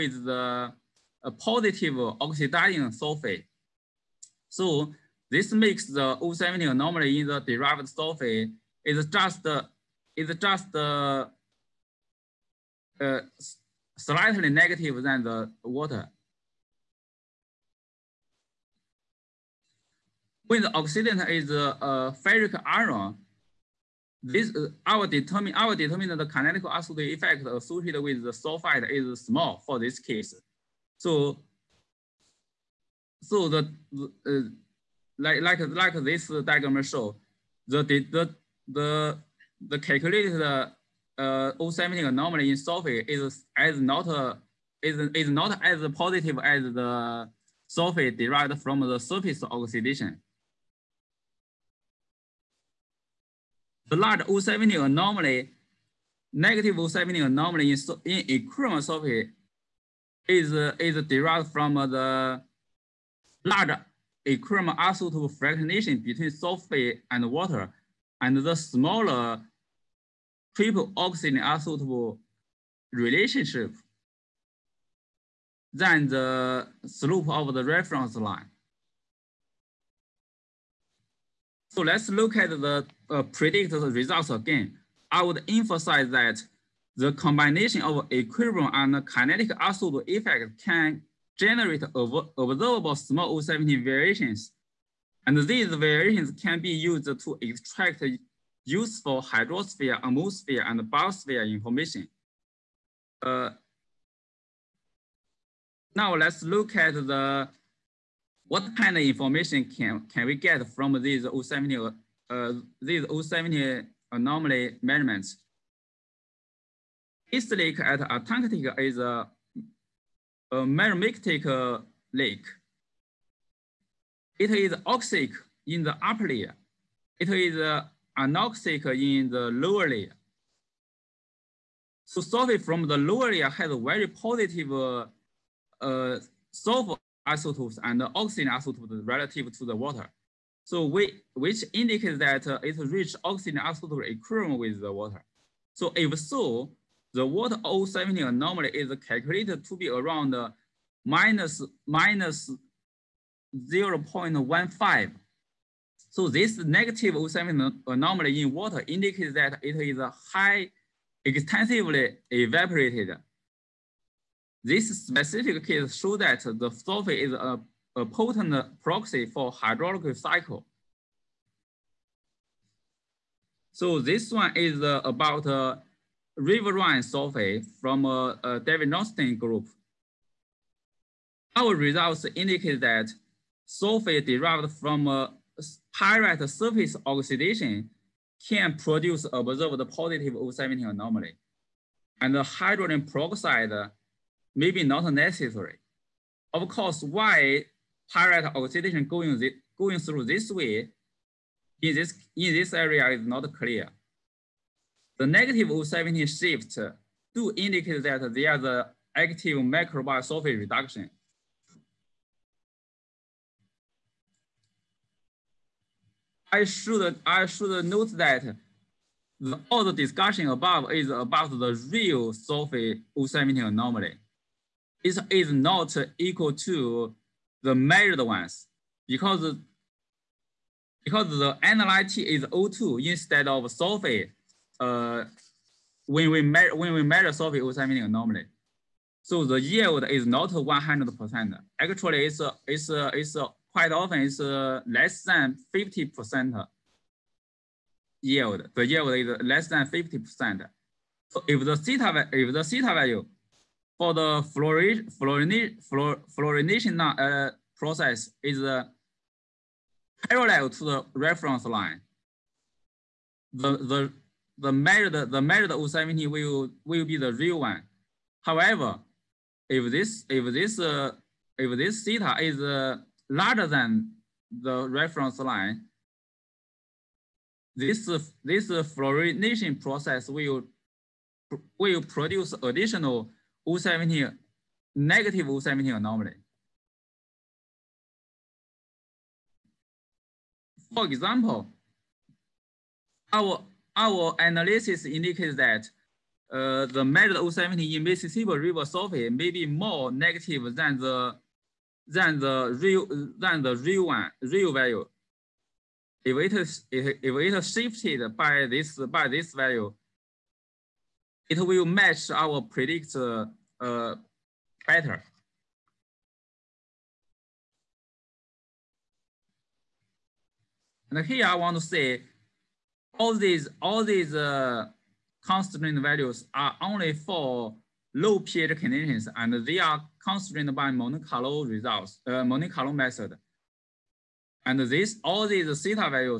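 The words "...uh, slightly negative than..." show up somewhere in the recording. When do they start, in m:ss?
0:12.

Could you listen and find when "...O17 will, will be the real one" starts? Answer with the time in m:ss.
4:25.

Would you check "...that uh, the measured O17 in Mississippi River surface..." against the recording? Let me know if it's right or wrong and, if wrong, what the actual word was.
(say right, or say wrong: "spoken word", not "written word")
right.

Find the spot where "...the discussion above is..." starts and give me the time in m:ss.
3:39.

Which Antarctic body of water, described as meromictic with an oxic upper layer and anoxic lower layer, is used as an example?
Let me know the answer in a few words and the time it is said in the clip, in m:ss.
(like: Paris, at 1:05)
East Lake, at 1:57.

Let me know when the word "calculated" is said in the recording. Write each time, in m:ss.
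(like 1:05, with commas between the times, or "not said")
0:39, 2:29.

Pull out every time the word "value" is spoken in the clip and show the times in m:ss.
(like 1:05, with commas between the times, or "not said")
4:12, 5:04, 5:09, 5:26.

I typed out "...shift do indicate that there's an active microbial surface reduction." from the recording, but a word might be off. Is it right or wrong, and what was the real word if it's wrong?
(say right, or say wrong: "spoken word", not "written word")
right.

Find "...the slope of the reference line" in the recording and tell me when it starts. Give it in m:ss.
1:16.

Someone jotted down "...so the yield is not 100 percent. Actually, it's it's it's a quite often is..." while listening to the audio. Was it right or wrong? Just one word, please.
right.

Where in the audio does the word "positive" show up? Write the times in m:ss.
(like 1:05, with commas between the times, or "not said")
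0:01, 0:45, 2:14, 3:09.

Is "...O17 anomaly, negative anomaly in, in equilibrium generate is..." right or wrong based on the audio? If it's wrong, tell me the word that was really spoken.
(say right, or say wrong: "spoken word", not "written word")
wrong: "sulfate", not "generate".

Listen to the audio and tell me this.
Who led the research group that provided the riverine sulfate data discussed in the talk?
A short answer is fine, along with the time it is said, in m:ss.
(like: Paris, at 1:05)
David Johnston, at 2:58.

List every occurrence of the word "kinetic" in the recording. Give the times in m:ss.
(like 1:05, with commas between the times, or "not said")
0:26, 1:29.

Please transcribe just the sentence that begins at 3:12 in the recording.
And the hydrogen peroxide may be not necessary.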